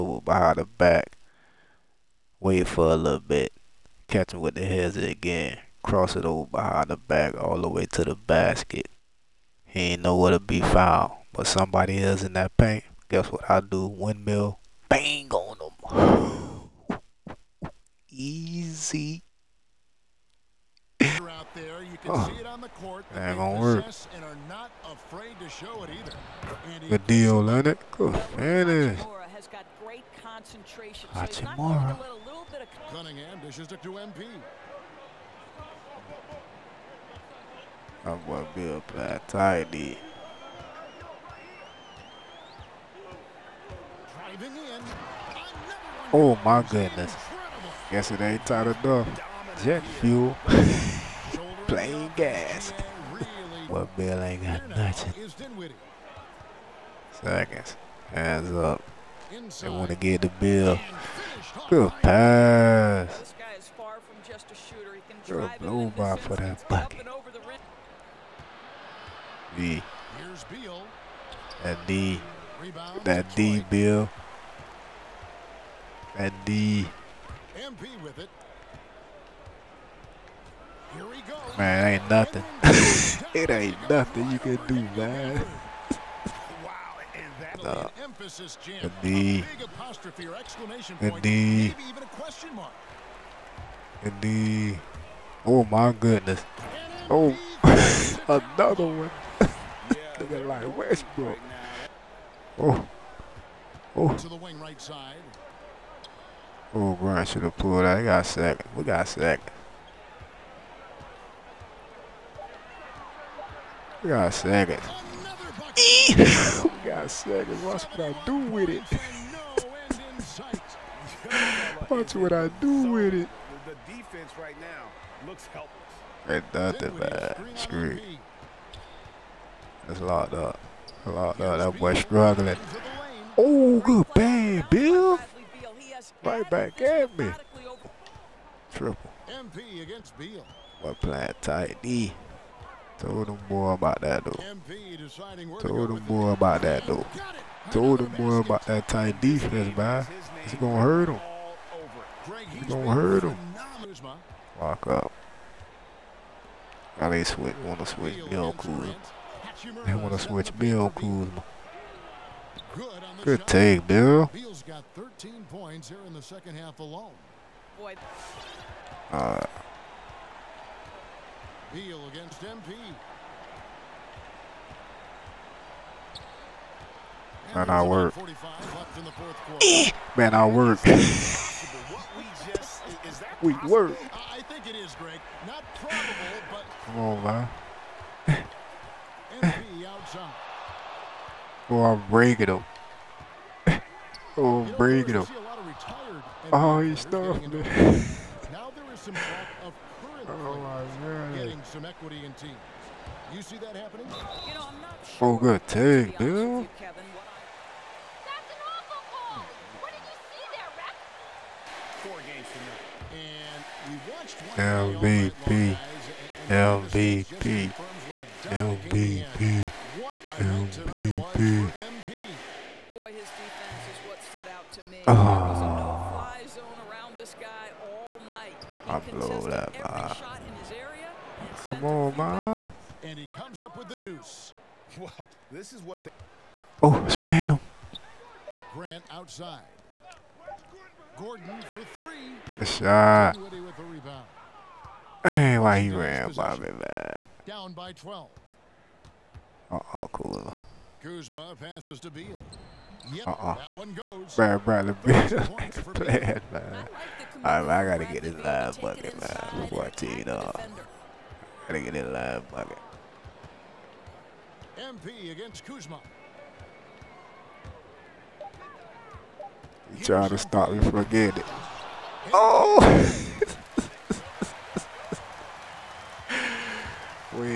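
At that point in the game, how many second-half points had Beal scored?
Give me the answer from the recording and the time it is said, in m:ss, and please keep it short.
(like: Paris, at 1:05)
13, at 2:44.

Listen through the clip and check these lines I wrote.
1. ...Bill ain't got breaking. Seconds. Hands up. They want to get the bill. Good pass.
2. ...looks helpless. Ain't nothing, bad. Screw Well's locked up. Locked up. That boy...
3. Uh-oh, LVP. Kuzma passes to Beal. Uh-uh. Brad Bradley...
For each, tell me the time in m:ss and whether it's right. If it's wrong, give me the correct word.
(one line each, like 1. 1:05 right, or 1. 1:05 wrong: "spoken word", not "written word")
1. 0:53 wrong: "nothing", not "breaking"
2. 2:05 wrong: "That", not "Well"
3. 4:09 wrong: "Kula", not "LVP".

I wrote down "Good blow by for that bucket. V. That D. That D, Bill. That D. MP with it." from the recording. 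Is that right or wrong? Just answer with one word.
right.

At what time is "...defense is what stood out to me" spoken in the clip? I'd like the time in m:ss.
3:43.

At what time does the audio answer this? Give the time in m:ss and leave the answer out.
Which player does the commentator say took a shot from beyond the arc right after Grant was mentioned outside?
4:01.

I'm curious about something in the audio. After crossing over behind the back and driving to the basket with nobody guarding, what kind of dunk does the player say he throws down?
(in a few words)
Windmill.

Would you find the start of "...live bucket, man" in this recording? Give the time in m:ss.
4:18.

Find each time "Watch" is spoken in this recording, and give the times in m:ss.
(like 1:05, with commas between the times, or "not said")
1:57, 2:01.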